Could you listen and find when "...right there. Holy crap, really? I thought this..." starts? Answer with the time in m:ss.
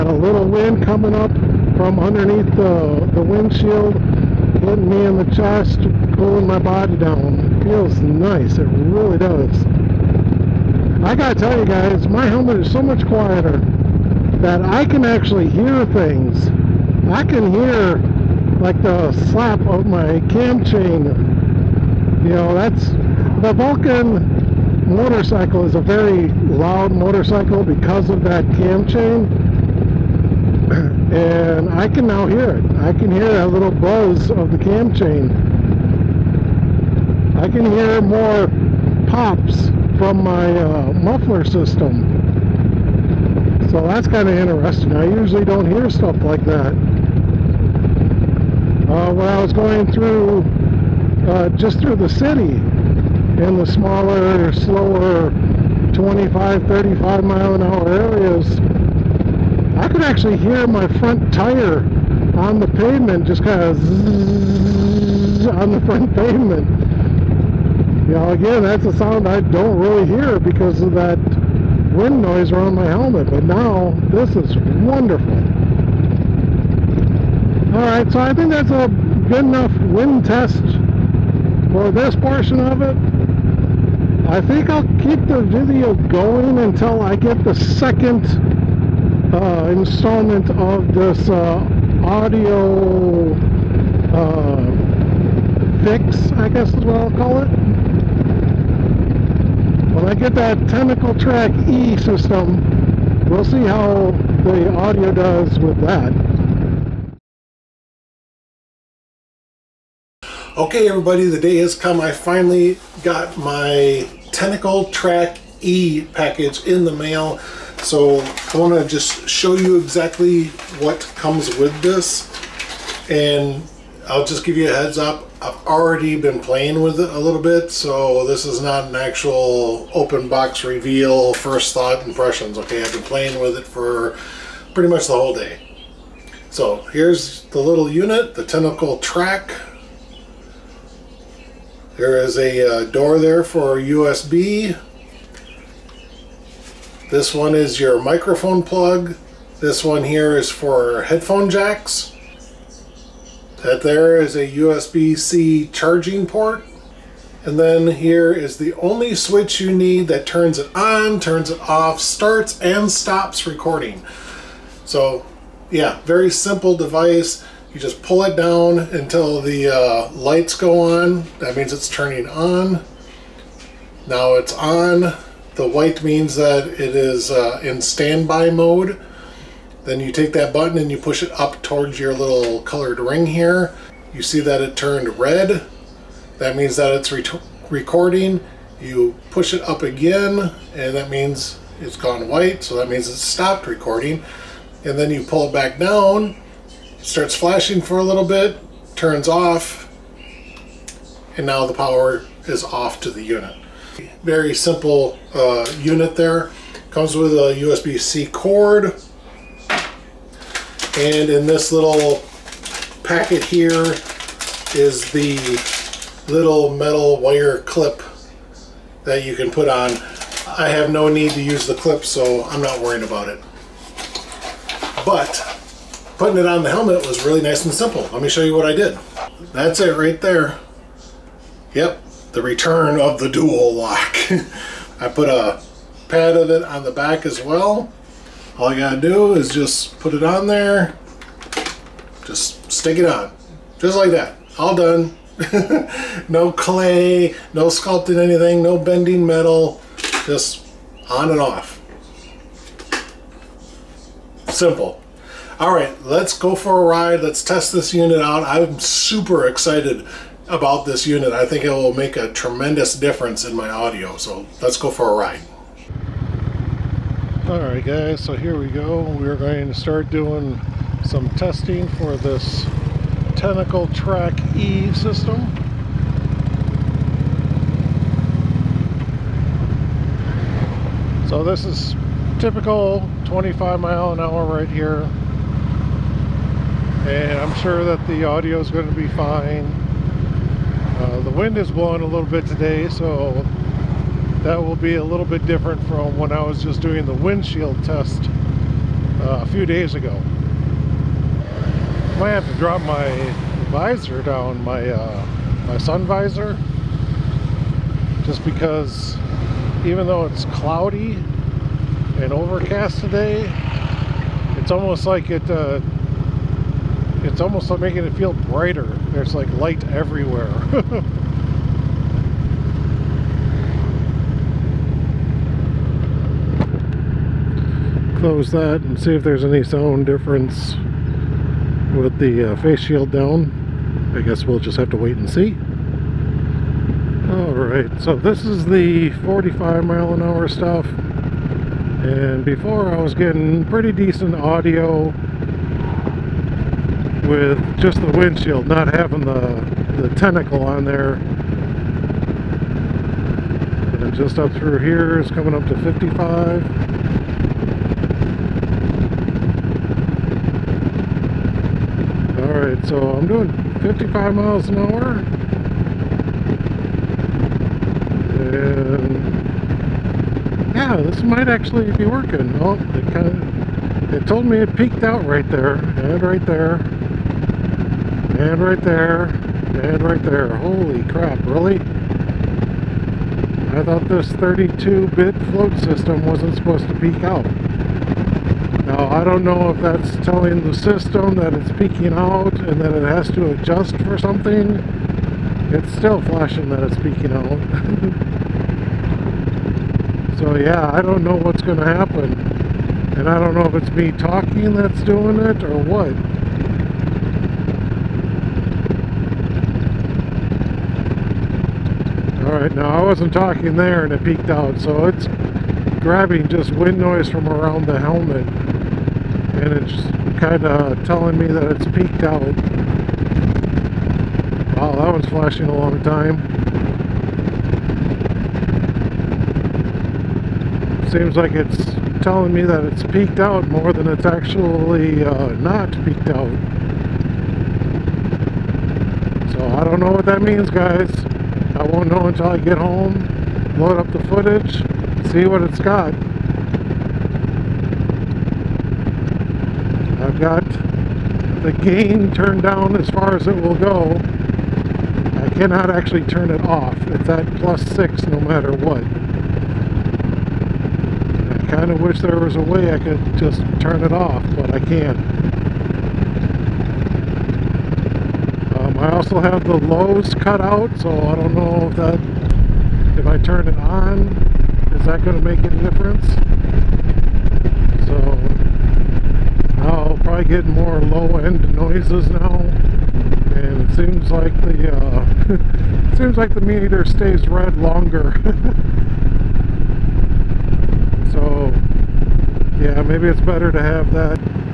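6:20.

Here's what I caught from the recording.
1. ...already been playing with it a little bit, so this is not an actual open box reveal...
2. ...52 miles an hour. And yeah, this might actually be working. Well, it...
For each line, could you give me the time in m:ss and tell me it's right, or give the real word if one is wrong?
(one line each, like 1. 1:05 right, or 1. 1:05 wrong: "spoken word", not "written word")
1. 2:05 right
2. 6:03 wrong: "55", not "52".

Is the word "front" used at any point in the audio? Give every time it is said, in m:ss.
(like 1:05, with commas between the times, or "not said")
1:00, 1:05.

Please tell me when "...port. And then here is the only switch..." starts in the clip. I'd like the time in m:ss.
2:36.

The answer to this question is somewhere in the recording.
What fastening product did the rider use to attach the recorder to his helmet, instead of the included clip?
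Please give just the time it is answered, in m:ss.
3:53.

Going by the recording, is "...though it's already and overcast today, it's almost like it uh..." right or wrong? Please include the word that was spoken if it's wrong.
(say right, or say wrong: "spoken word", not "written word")
wrong: "cloudy", not "already".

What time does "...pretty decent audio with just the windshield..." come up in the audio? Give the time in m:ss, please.
5:43.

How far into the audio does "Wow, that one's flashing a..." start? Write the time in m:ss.
7:04.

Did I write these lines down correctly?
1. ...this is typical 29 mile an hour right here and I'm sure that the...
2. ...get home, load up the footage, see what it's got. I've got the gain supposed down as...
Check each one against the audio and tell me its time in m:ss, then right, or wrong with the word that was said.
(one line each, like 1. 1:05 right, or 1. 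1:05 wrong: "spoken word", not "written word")
1. 4:41 wrong: "25", not "29"
2. 7:22 wrong: "turned", not "supposed".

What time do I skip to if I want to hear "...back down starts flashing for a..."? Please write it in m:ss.
3:15.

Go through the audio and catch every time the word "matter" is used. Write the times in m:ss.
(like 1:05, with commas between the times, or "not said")
7:38.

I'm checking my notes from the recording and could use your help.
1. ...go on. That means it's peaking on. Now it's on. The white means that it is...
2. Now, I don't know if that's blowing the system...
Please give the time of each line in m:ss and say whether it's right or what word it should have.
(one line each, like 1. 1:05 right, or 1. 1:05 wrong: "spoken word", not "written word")
1. 2:50 wrong: "turning", not "peaking"
2. 6:28 wrong: "telling", not "blowing".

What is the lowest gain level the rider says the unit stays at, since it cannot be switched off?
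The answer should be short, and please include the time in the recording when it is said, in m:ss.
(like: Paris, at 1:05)
+6, at 7:37.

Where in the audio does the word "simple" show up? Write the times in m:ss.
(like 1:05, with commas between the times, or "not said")
2:46, 3:24, 3:47, 4:14.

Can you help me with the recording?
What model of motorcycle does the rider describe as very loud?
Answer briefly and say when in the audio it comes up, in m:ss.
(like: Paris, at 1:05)
Vulcan, at 0:23.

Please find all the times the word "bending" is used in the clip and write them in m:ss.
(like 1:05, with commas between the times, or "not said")
4:08.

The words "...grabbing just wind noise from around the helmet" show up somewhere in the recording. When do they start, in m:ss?
6:56.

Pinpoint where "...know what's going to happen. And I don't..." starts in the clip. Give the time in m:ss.
6:41.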